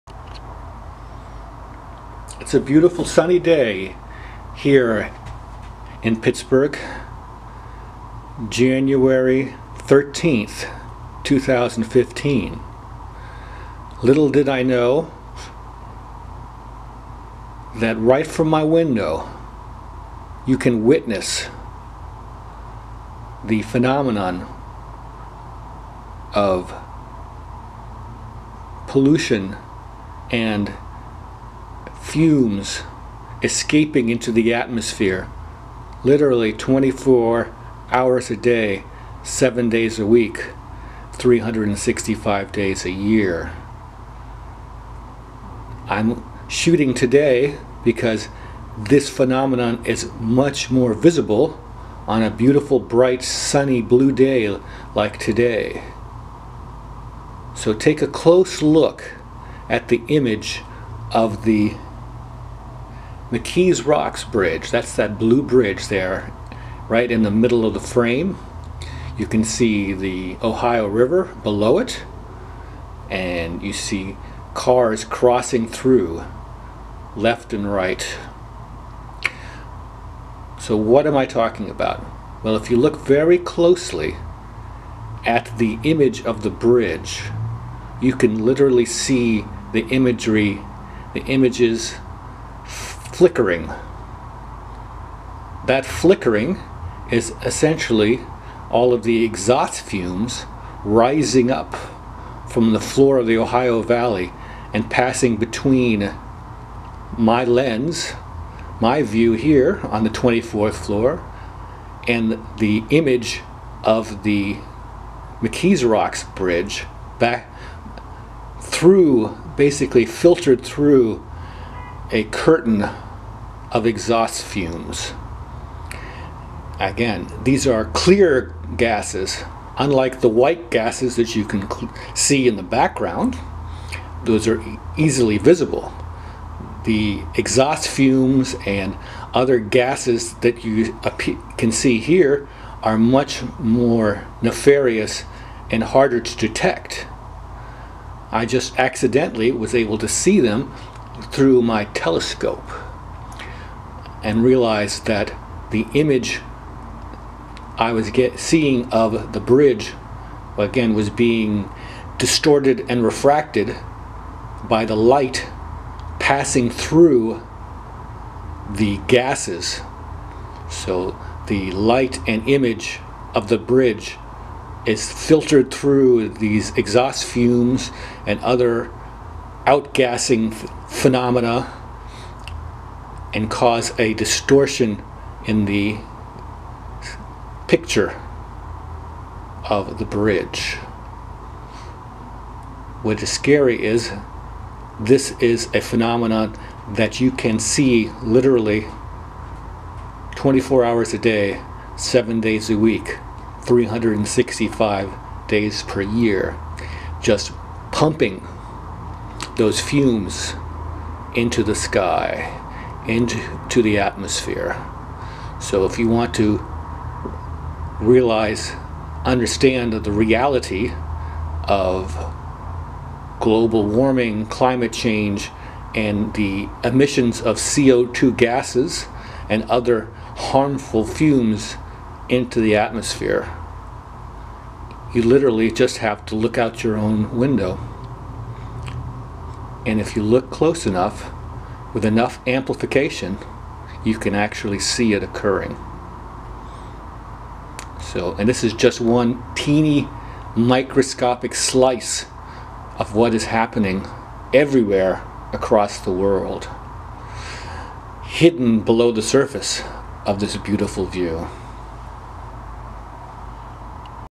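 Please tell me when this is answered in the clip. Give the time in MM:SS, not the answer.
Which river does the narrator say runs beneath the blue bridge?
01:10.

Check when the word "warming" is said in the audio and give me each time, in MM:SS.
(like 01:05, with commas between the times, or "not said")
03:43.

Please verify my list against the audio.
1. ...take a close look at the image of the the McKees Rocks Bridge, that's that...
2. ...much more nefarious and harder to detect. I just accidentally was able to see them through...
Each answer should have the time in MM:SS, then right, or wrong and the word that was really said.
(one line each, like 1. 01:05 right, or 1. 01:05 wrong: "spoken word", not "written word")
1. 00:57 right
2. 02:22 right.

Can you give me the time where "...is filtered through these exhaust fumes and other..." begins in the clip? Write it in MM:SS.
02:54.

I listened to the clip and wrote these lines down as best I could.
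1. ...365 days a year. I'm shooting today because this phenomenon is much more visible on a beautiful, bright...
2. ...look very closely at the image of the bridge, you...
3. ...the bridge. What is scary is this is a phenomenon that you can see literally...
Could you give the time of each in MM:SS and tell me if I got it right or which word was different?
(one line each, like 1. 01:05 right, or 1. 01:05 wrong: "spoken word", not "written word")
1. 00:41 right
2. 01:22 right
3. 03:09 right.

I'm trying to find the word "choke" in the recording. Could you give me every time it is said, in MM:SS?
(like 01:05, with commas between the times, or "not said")
not said.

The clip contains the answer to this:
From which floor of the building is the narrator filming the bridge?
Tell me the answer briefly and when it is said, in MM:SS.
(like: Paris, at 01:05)
24th floor, at 01:50.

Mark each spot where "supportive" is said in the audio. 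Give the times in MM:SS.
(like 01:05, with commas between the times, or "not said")
not said.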